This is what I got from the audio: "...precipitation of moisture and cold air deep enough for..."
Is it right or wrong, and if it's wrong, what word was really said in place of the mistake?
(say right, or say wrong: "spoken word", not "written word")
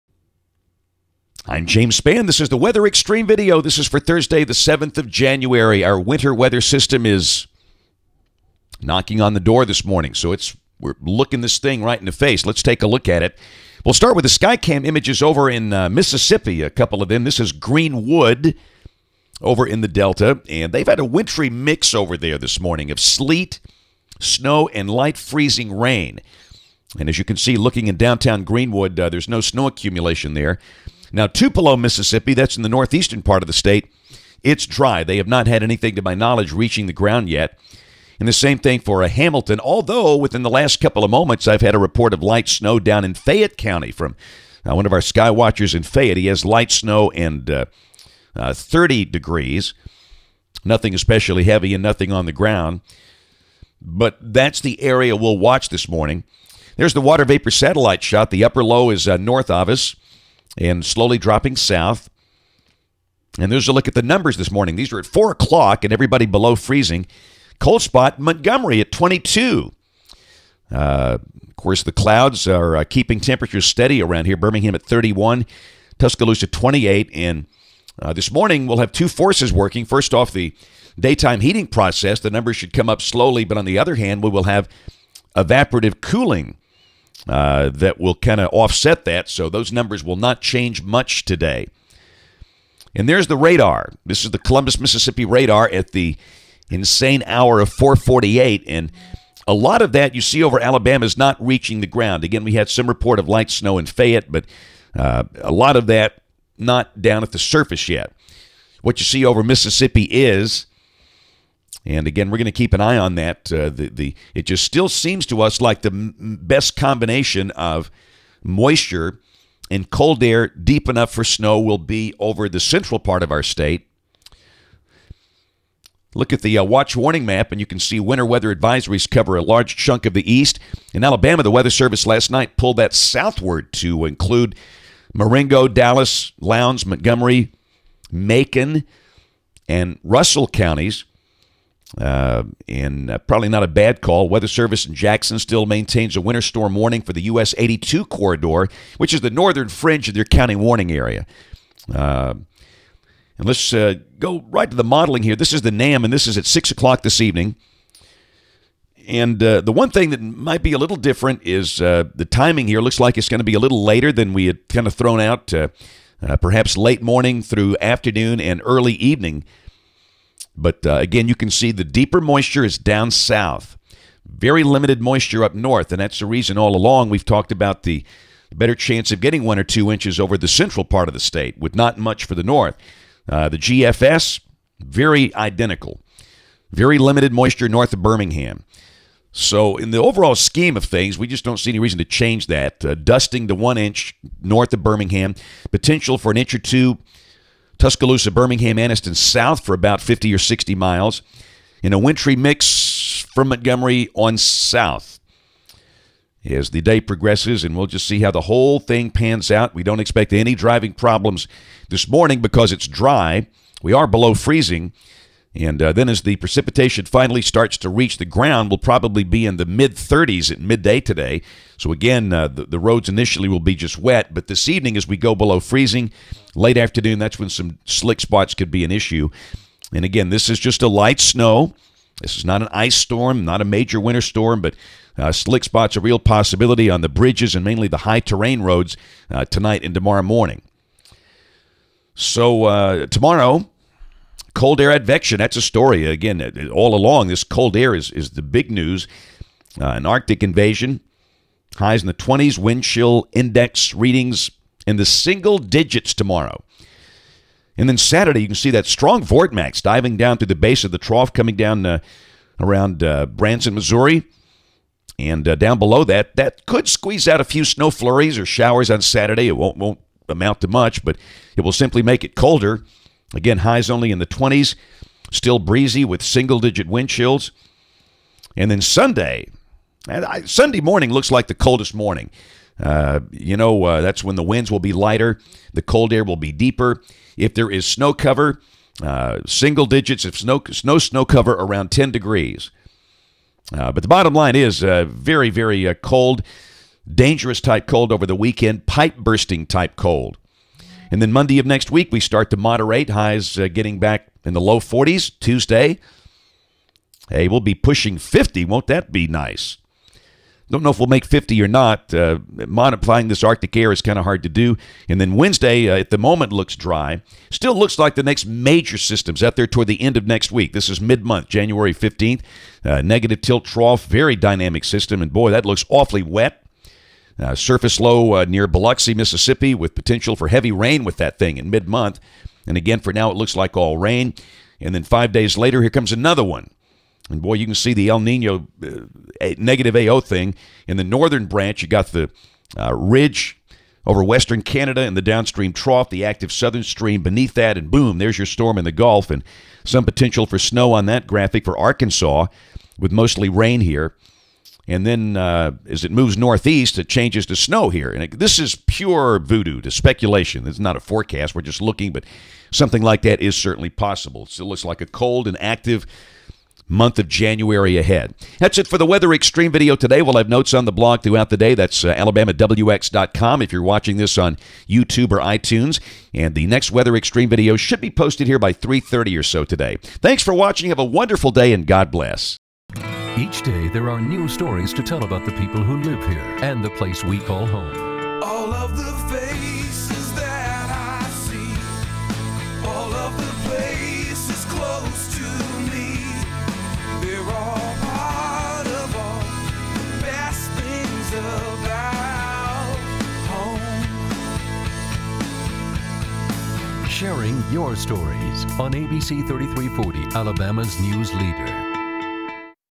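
wrong: "combination", not "precipitation".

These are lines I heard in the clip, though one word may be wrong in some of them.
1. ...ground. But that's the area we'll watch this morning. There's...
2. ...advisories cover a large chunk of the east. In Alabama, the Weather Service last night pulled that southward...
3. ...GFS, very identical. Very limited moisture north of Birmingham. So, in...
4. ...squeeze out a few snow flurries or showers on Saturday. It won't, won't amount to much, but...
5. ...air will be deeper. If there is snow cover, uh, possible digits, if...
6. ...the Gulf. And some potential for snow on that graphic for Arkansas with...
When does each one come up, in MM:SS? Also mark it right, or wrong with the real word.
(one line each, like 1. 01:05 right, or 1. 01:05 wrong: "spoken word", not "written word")
1. 00:52 right
2. 02:08 right
3. 03:03 right
4. 04:26 right
5. 04:46 wrong: "single", not "possible"
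6. 05:48 right.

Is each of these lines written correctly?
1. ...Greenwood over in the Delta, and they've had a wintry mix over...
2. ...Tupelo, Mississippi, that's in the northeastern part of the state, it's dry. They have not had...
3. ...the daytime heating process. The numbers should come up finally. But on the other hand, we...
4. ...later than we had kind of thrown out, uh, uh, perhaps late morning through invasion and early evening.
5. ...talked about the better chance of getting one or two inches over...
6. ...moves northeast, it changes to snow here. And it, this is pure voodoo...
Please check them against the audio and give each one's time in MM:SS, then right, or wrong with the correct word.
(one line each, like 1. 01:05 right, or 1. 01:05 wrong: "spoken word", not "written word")
1. 00:17 right
2. 00:31 right
3. 01:20 wrong: "slowly", not "finally"
4. 02:43 wrong: "afternoon", not "invasion"
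5. 02:57 right
6. 05:56 right.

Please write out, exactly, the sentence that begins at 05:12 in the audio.
Uh, modifying this Arctic air is kind of hard to do.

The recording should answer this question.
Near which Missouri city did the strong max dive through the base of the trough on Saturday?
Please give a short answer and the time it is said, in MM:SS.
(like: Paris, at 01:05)
Branson, at 04:23.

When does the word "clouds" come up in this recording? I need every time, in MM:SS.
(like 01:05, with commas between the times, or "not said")
01:11.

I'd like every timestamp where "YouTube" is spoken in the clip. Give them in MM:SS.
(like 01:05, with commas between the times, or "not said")
06:14.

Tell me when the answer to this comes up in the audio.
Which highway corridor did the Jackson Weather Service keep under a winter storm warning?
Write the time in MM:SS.
02:27.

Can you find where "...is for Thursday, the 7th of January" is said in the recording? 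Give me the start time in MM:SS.
00:03.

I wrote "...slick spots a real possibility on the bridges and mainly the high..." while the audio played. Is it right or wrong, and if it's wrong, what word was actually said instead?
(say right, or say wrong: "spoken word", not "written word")
right.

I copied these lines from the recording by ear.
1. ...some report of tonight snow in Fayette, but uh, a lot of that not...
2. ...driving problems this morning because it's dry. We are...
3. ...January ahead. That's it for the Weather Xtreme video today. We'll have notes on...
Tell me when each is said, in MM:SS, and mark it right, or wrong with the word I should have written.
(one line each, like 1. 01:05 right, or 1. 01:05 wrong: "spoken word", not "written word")
1. 01:42 wrong: "light", not "tonight"
2. 03:30 right
3. 06:07 right.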